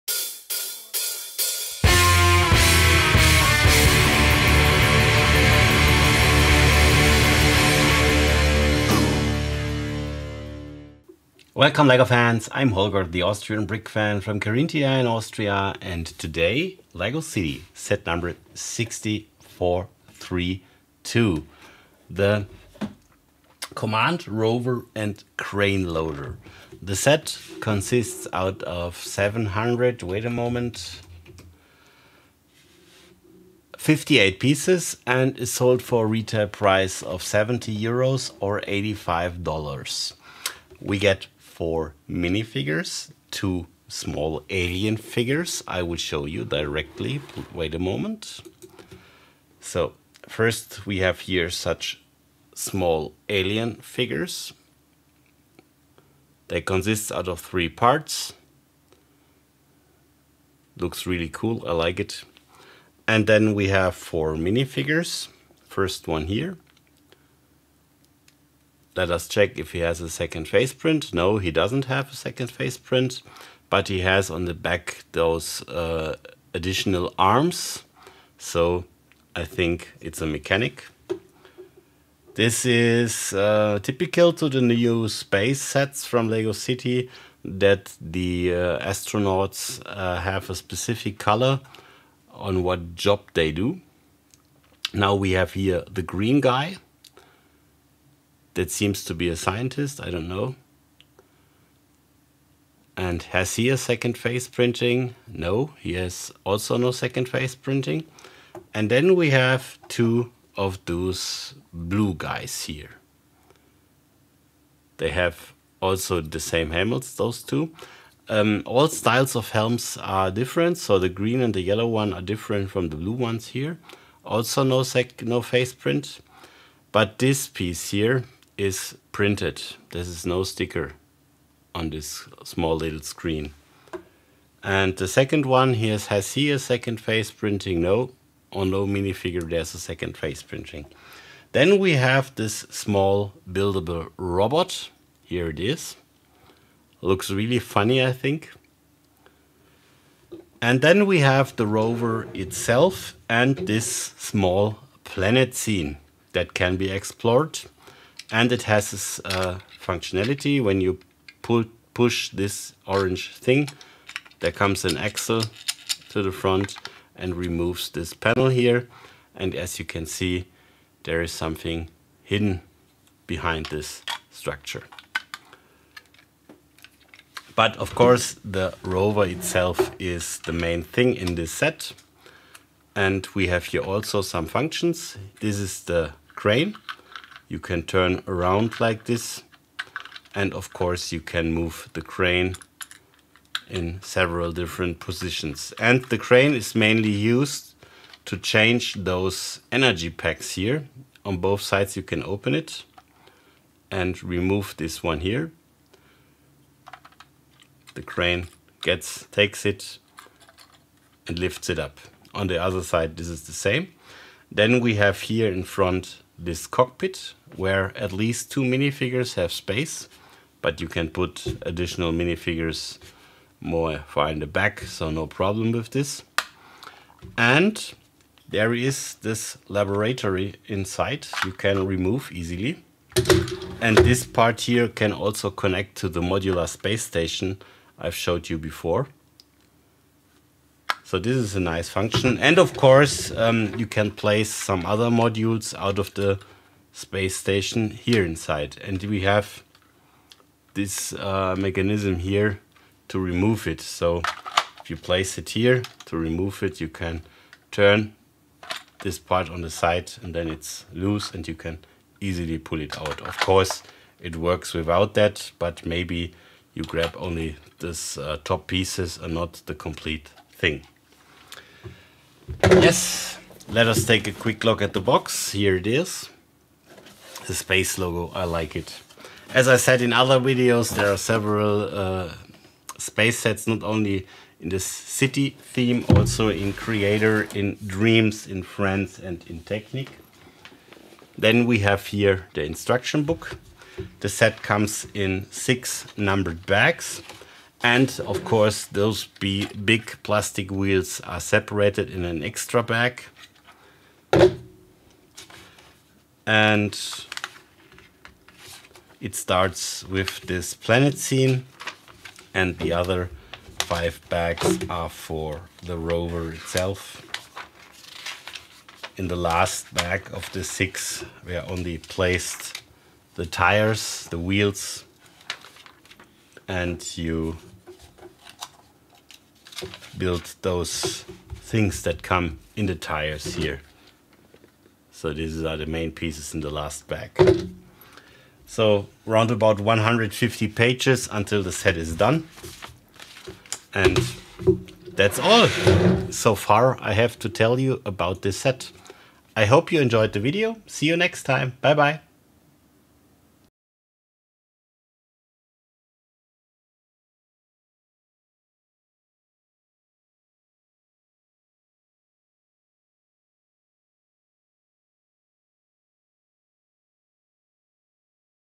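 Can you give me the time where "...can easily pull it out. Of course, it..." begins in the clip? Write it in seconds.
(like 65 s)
261 s.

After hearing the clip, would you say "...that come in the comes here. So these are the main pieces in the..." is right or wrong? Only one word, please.
wrong.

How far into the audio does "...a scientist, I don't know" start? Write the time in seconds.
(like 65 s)
99 s.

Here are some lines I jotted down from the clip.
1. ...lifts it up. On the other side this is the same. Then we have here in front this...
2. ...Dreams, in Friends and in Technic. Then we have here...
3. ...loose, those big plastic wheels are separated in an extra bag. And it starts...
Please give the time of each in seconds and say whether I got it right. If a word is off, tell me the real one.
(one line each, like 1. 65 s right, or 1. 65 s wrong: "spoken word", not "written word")
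1. 211 s right
2. 287 s right
3. 298 s wrong: "course", not "loose".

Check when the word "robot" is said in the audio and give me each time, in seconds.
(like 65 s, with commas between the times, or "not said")
144 s.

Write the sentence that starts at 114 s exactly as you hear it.
They have also the same helmets, those two.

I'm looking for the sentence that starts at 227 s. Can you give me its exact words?
And there is this laboratory inside you can remove easily.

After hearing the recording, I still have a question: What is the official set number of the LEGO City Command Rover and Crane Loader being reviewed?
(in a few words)
6432.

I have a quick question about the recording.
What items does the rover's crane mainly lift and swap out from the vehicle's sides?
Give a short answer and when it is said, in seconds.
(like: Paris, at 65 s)
energy packs, at 199 s.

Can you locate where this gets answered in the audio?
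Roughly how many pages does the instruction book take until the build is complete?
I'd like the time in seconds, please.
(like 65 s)
339 s.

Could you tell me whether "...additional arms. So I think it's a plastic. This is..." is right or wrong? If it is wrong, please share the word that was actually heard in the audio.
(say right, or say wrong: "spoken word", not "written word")
wrong: "mechanic", not "plastic".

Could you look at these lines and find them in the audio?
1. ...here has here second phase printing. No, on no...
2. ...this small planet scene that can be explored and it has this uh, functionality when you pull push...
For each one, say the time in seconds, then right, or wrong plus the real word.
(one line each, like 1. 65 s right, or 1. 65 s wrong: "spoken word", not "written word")
1. 135 s right
2. 153 s right.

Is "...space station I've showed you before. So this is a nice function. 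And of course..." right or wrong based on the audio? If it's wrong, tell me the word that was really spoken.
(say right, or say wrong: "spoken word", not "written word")
right.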